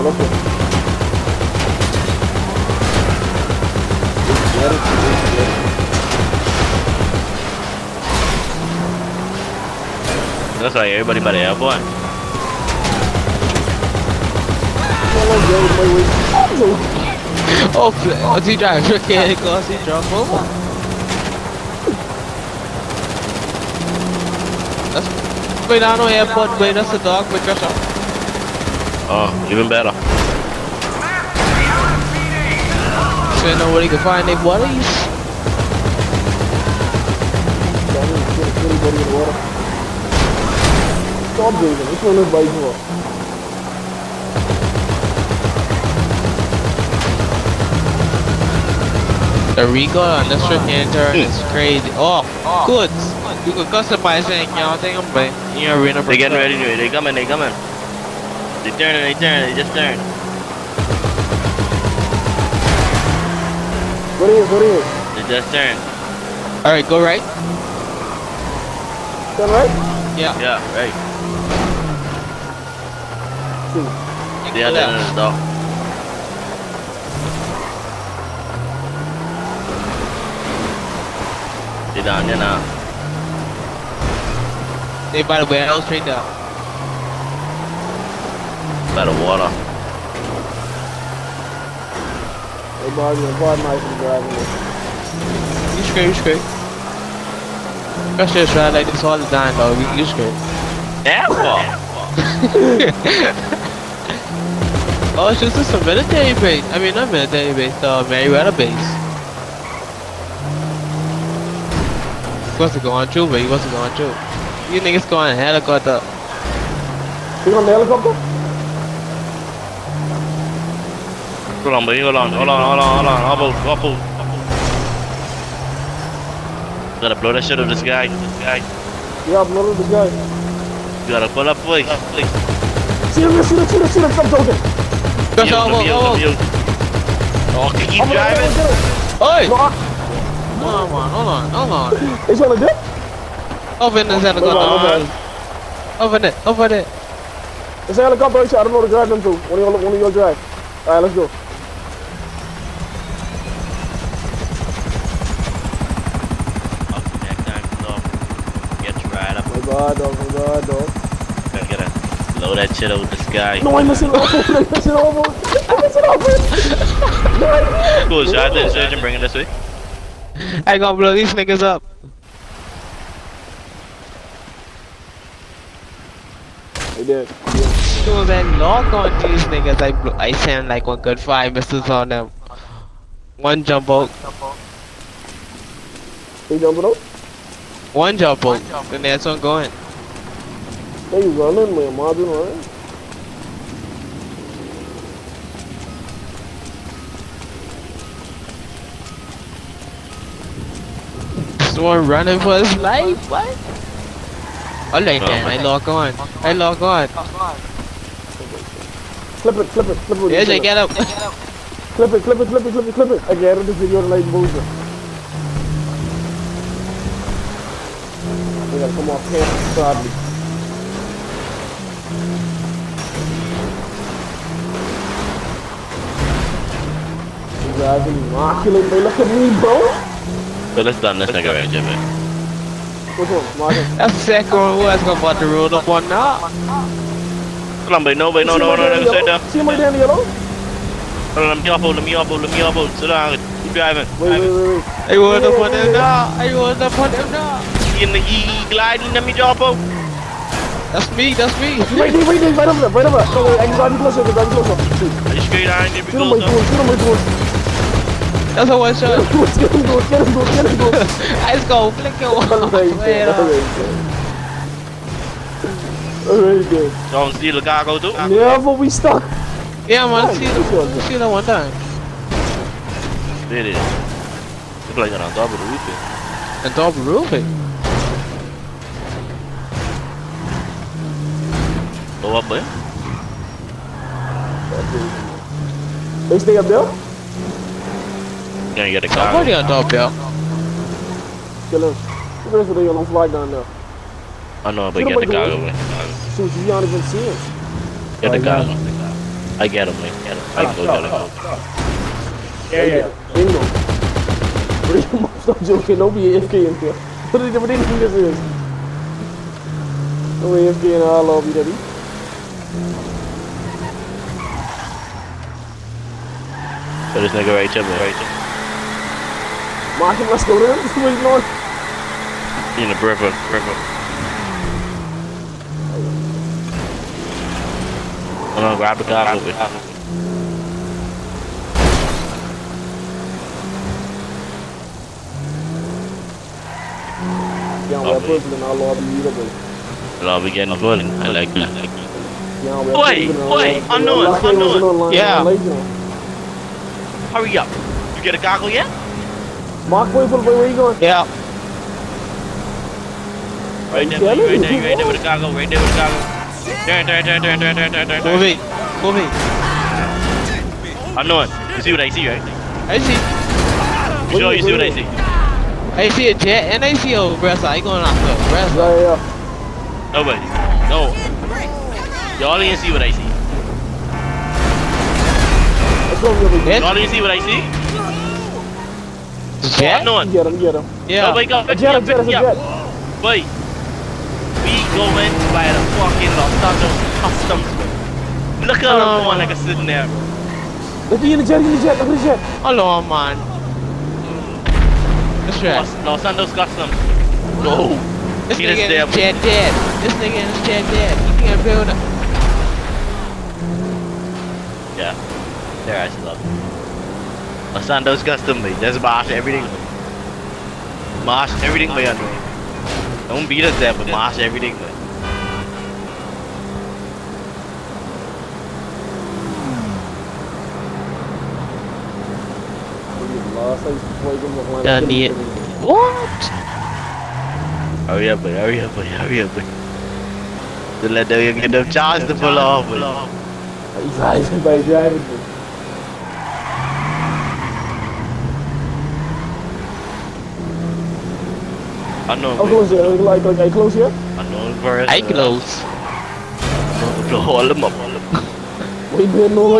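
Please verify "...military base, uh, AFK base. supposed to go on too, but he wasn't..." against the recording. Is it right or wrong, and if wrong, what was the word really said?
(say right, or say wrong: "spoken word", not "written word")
wrong: "Merryweather", not "AFK".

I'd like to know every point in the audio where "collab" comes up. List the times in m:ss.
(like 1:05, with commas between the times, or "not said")
not said.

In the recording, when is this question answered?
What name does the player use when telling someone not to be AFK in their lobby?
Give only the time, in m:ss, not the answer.
5:11.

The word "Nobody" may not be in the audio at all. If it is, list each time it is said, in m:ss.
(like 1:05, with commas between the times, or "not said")
6:10, 6:21.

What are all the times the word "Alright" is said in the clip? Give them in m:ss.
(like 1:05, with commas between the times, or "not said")
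1:06, 2:30, 4:26.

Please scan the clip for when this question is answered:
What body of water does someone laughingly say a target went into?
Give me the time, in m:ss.
5:22.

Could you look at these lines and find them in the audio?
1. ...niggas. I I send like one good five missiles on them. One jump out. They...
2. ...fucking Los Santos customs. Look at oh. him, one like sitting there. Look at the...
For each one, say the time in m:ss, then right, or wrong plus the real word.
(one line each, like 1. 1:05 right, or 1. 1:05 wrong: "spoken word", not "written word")
1. 2:59 right
2. 6:25 right.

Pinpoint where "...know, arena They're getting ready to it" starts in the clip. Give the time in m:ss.
0:55.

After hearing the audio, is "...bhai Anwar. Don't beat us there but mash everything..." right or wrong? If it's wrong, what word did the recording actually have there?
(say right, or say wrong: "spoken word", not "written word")
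right.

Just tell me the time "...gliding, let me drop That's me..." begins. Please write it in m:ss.
4:08.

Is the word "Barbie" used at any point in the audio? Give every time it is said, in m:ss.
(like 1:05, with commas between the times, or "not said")
1:32.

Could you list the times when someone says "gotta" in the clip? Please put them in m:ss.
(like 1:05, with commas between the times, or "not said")
2:07, 2:11, 2:41, 2:50, 3:38.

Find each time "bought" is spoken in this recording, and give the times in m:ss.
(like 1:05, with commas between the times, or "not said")
3:55.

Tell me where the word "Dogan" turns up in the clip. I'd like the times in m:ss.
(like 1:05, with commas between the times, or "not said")
2:15.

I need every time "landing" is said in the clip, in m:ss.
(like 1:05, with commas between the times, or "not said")
not said.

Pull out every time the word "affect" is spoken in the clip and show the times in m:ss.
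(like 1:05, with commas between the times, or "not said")
not said.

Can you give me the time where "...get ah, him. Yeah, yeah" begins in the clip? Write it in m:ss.
5:00.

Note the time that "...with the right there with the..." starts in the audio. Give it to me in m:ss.
5:55.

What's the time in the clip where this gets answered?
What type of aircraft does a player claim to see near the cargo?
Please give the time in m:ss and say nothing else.
6:05.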